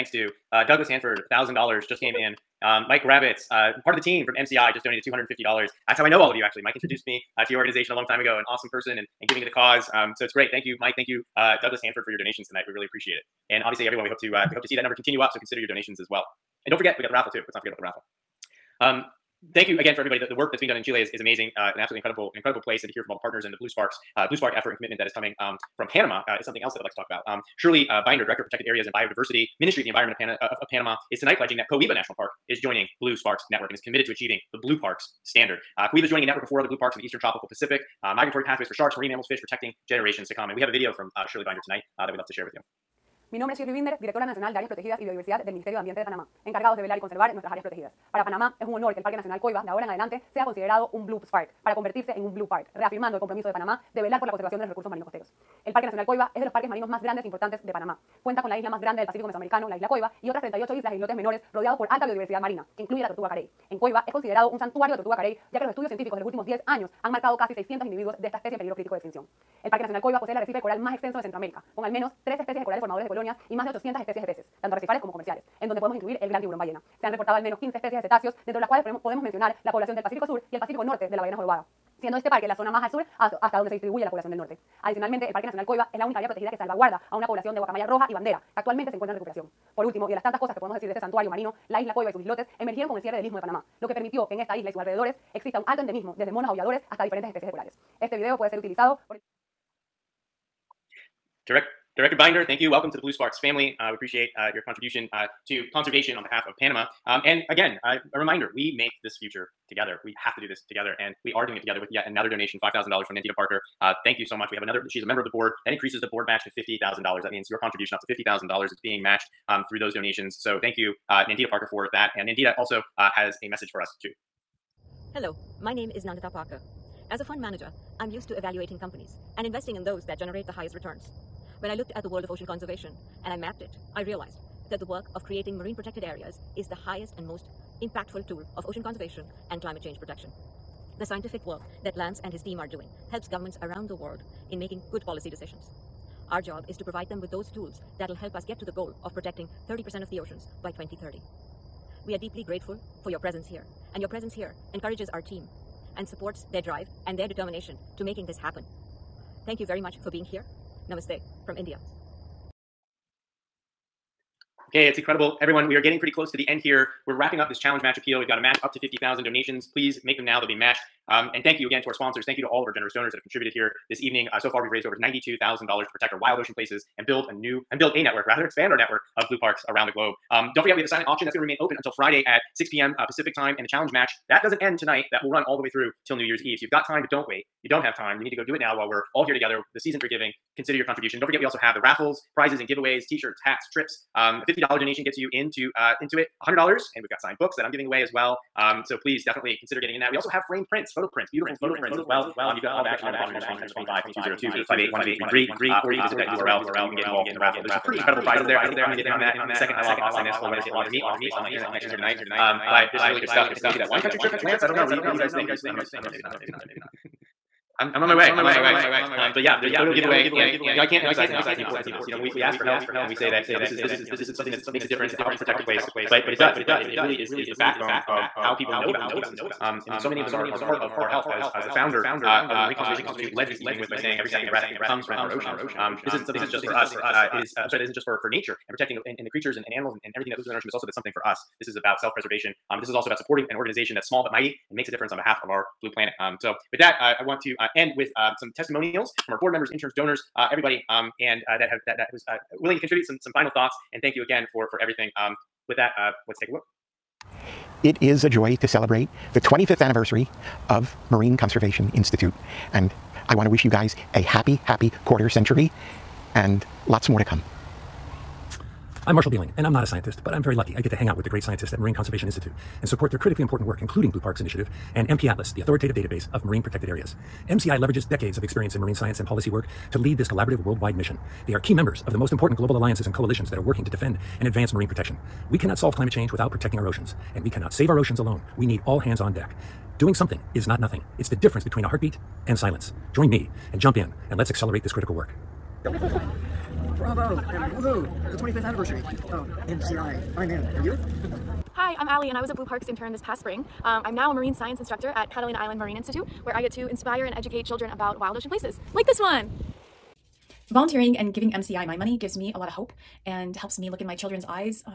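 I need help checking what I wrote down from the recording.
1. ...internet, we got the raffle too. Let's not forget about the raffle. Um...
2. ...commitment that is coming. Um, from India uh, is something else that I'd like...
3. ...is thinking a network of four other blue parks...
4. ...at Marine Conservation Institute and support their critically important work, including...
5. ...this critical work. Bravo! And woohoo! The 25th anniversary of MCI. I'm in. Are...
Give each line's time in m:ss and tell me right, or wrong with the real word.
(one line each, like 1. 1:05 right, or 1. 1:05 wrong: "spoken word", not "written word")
1. 0:16 wrong: "forget", not "internet"
2. 0:24 wrong: "Panama", not "India"
3. 0:36 wrong: "joining", not "thinking"
4. 4:31 right
5. 4:54 right.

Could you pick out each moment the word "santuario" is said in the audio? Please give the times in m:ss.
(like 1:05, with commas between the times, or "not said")
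1:04, 1:30.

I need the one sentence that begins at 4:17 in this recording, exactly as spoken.
It is a joy to celebrate the 25th anniversary of Marine Conservation Institute.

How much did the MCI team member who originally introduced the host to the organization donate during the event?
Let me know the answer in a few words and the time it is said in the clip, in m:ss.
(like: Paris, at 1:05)
$250, at 0:05.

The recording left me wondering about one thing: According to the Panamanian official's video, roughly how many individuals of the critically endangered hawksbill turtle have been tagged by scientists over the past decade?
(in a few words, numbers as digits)
600.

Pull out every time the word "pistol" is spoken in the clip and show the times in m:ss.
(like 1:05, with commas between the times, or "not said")
not said.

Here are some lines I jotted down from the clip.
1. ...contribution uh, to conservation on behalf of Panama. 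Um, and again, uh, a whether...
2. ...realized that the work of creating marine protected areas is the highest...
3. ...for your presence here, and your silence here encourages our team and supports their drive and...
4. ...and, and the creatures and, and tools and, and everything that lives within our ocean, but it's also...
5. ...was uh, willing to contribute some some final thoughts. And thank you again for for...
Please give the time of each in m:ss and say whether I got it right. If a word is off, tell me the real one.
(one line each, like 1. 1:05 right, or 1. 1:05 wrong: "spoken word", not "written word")
1. 1:44 wrong: "reminder", not "whether"
2. 2:14 right
3. 2:33 wrong: "presence", not "silence"
4. 3:59 wrong: "animals", not "tools"
5. 4:12 right.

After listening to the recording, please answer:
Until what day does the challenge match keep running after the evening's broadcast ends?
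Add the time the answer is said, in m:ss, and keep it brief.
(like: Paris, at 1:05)
New Year's Eve, at 3:06.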